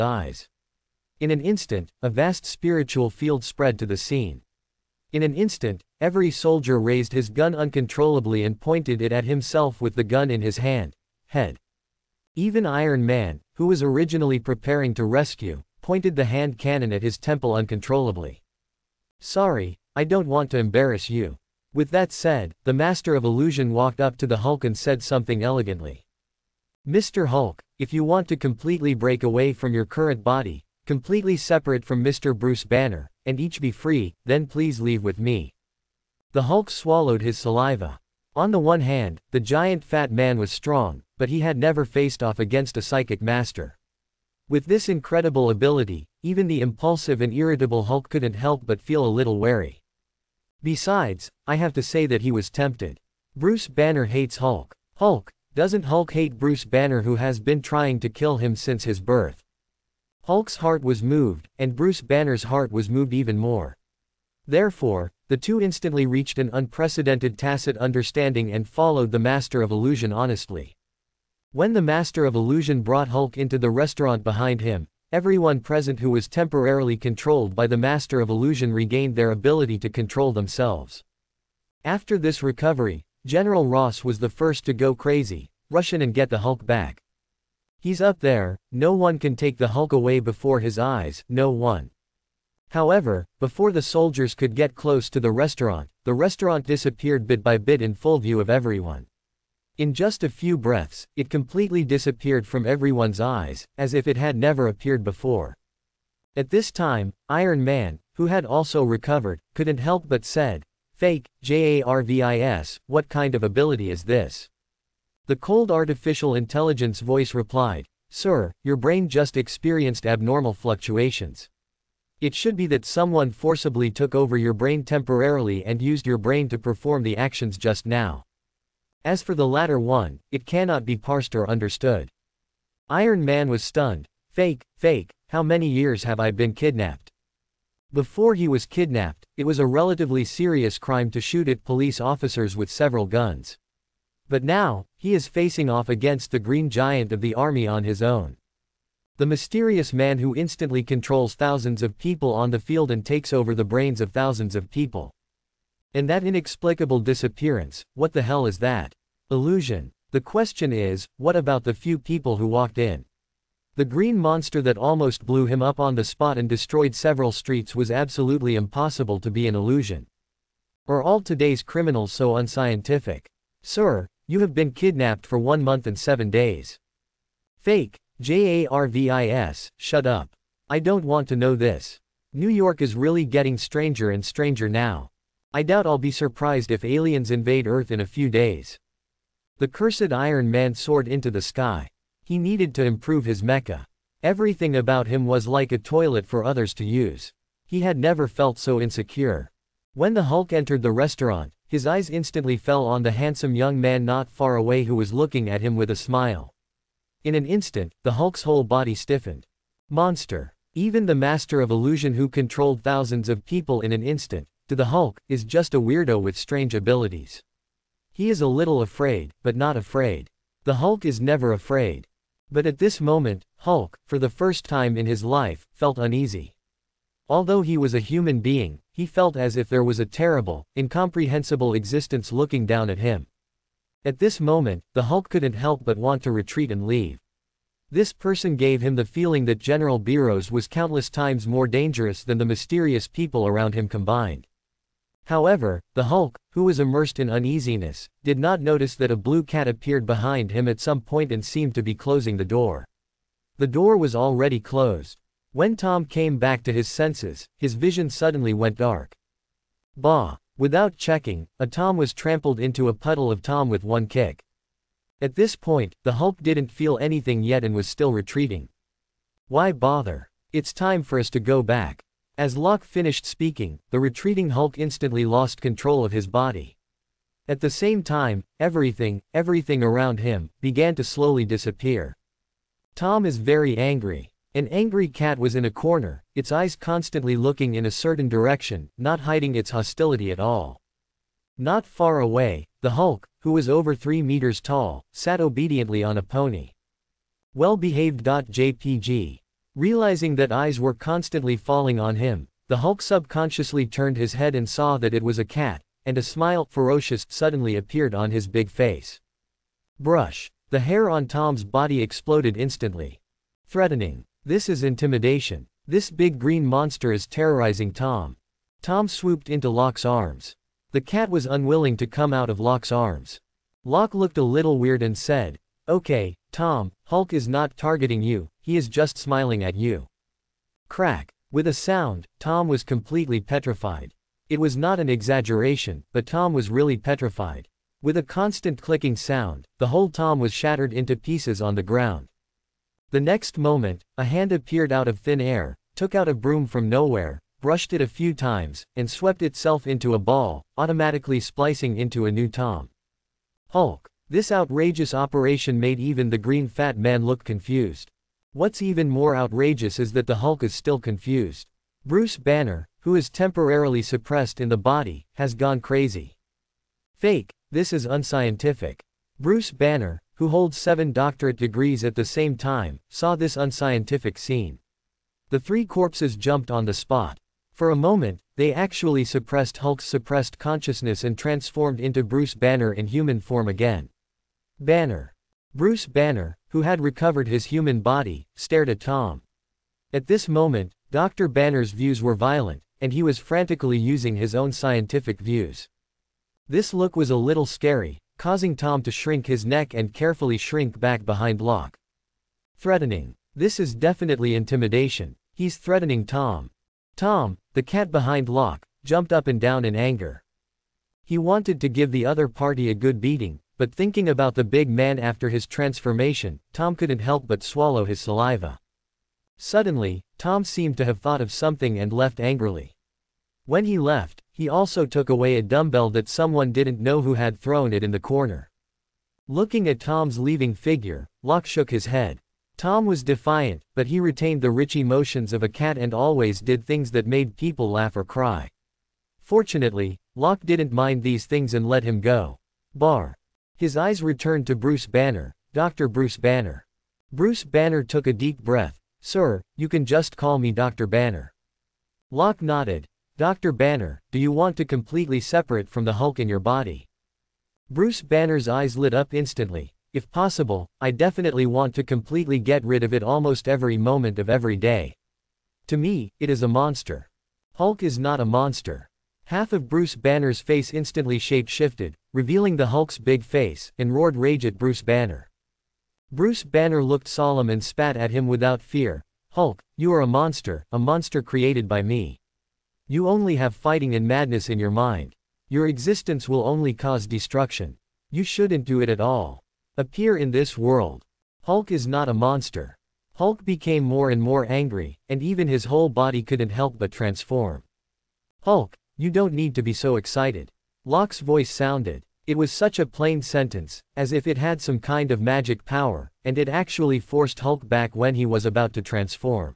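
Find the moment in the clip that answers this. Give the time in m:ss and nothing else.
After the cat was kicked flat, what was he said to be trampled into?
4:22.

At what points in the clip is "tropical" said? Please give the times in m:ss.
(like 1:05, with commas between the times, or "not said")
not said.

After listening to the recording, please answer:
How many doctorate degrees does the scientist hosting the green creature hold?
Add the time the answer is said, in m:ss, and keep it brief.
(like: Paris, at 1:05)
7, at 6:10.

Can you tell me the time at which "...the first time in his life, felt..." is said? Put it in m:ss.
3:44.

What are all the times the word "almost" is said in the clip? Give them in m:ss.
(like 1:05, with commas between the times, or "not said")
2:44, 7:43.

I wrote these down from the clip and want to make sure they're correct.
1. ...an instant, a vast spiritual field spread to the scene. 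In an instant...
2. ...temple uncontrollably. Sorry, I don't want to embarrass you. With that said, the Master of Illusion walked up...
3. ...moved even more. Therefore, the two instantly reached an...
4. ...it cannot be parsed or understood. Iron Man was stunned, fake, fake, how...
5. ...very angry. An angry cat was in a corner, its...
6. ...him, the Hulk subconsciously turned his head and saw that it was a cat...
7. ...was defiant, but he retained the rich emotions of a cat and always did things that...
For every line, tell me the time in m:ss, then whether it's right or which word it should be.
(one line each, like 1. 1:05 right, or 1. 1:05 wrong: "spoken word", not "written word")
1. 0:01 right
2. 0:17 right
3. 1:02 right
4. 2:10 right
5. 4:43 right
6. 5:02 right
7. 7:13 right.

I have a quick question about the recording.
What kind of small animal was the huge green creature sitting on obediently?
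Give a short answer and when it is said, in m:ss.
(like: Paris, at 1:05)
a pony, at 4:56.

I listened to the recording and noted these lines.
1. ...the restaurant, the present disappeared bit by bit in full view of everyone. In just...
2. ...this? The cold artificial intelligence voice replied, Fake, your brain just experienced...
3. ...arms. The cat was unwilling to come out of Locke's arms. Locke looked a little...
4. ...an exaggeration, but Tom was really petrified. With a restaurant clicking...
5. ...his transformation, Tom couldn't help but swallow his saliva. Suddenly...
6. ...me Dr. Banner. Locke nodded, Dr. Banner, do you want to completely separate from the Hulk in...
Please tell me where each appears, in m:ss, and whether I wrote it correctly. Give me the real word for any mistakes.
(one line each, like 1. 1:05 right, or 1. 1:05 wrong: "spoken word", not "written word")
1. 1:35 wrong: "restaurant", not "present"
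2. 1:54 wrong: "Sir", not "Fake"
3. 5:20 right
4. 5:34 wrong: "constant", not "restaurant"
5. 6:55 right
6. 7:30 right.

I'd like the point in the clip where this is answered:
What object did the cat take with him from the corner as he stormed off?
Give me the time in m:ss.
7:05.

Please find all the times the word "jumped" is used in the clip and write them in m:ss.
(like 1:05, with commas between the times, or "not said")
6:16, 6:49.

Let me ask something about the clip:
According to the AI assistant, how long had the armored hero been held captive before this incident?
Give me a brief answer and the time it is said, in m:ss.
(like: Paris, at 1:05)
1 month and 7 days, at 2:55.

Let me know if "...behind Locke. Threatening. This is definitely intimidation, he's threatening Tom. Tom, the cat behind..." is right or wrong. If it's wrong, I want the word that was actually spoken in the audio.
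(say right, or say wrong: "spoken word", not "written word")
right.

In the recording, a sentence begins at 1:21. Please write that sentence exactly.
After this recovery, General Ross was the first to go crazy, rush in and get the Hulk back.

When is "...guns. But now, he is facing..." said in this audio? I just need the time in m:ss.
2:23.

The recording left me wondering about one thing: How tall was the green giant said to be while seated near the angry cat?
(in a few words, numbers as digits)
over 3 meters.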